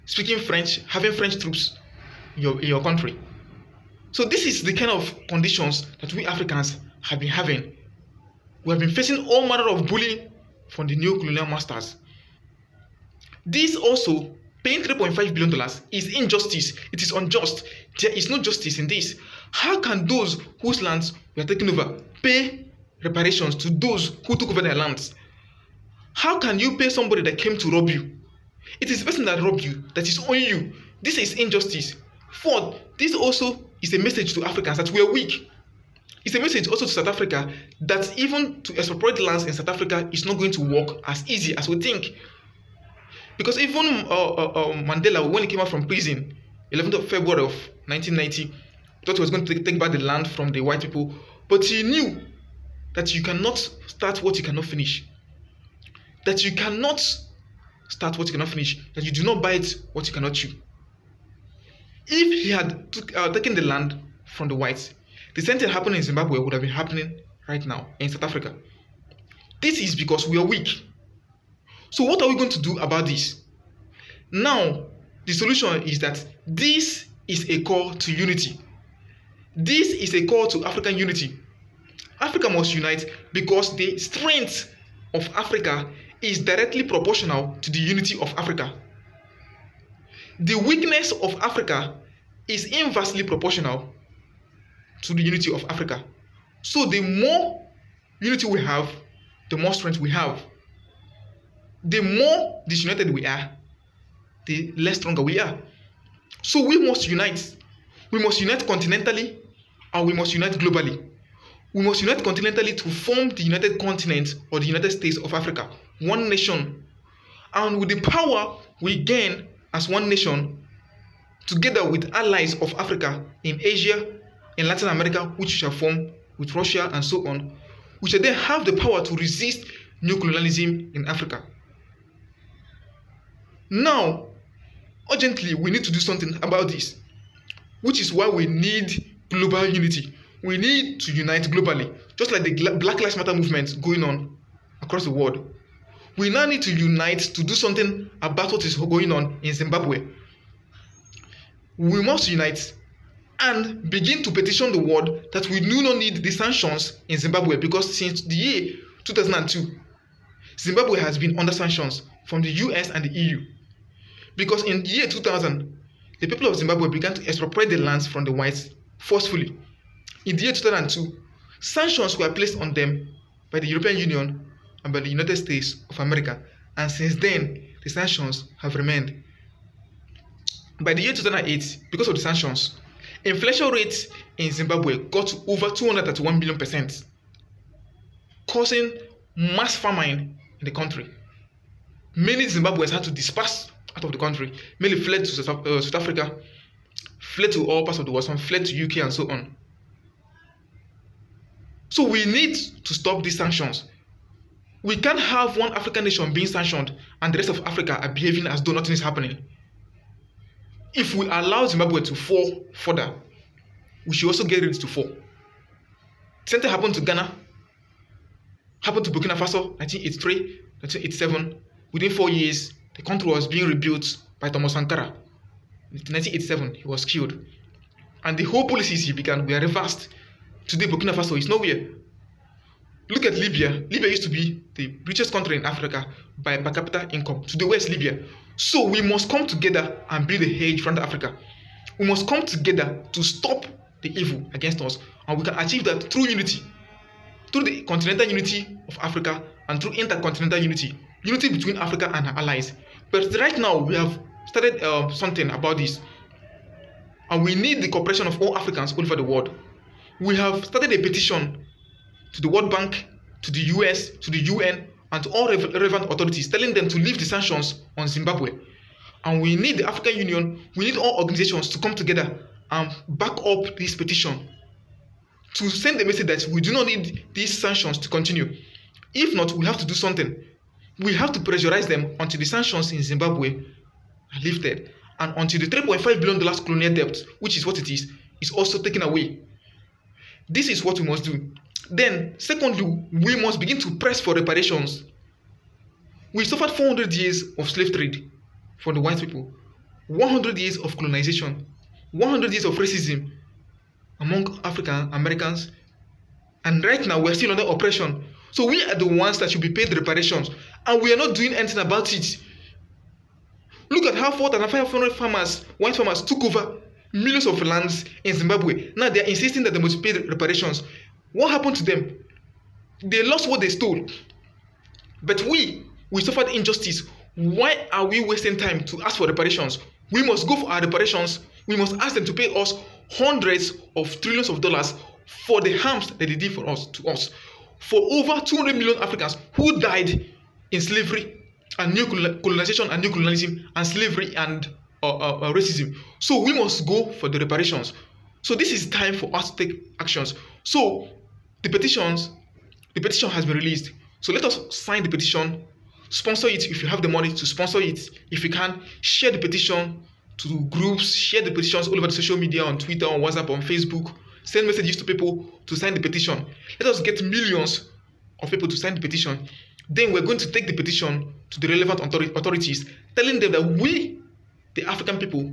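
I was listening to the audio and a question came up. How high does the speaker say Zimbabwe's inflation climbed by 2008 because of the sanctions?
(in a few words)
231 billion percent.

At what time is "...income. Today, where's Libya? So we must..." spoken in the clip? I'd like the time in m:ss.
3:57.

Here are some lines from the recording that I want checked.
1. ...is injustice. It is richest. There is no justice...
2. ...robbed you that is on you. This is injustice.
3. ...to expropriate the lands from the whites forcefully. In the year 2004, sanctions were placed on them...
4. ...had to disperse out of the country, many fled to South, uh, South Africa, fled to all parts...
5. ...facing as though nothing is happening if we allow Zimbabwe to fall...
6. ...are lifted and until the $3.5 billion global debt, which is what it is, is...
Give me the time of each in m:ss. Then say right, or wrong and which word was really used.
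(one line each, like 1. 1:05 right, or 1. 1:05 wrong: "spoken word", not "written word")
1. 0:15 wrong: "unjust", not "richest"
2. 0:29 right
3. 2:47 wrong: "2002", not "2004"
4. 3:12 right
5. 3:28 wrong: "behaving", not "facing"
6. 4:43 wrong: "colonial", not "global".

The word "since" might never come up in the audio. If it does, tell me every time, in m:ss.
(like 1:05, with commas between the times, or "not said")
2:37, 2:56.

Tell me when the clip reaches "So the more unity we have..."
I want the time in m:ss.
1:36.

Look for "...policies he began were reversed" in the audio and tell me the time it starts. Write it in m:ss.
3:48.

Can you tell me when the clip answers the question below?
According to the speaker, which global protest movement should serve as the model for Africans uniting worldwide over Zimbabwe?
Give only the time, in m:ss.
2:22.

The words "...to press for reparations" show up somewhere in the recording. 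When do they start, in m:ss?
4:53.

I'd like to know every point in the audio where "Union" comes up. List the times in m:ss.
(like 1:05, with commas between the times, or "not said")
2:53, 4:30.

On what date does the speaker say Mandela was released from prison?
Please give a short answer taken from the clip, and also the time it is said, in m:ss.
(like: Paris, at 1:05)
11 February 1990, at 0:46.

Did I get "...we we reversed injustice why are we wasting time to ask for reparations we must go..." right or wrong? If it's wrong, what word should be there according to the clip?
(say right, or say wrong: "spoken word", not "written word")
wrong: "suffered", not "reversed".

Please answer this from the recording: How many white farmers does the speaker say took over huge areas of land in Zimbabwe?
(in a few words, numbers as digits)
4,500.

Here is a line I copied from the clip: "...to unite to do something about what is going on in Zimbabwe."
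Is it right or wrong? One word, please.
right.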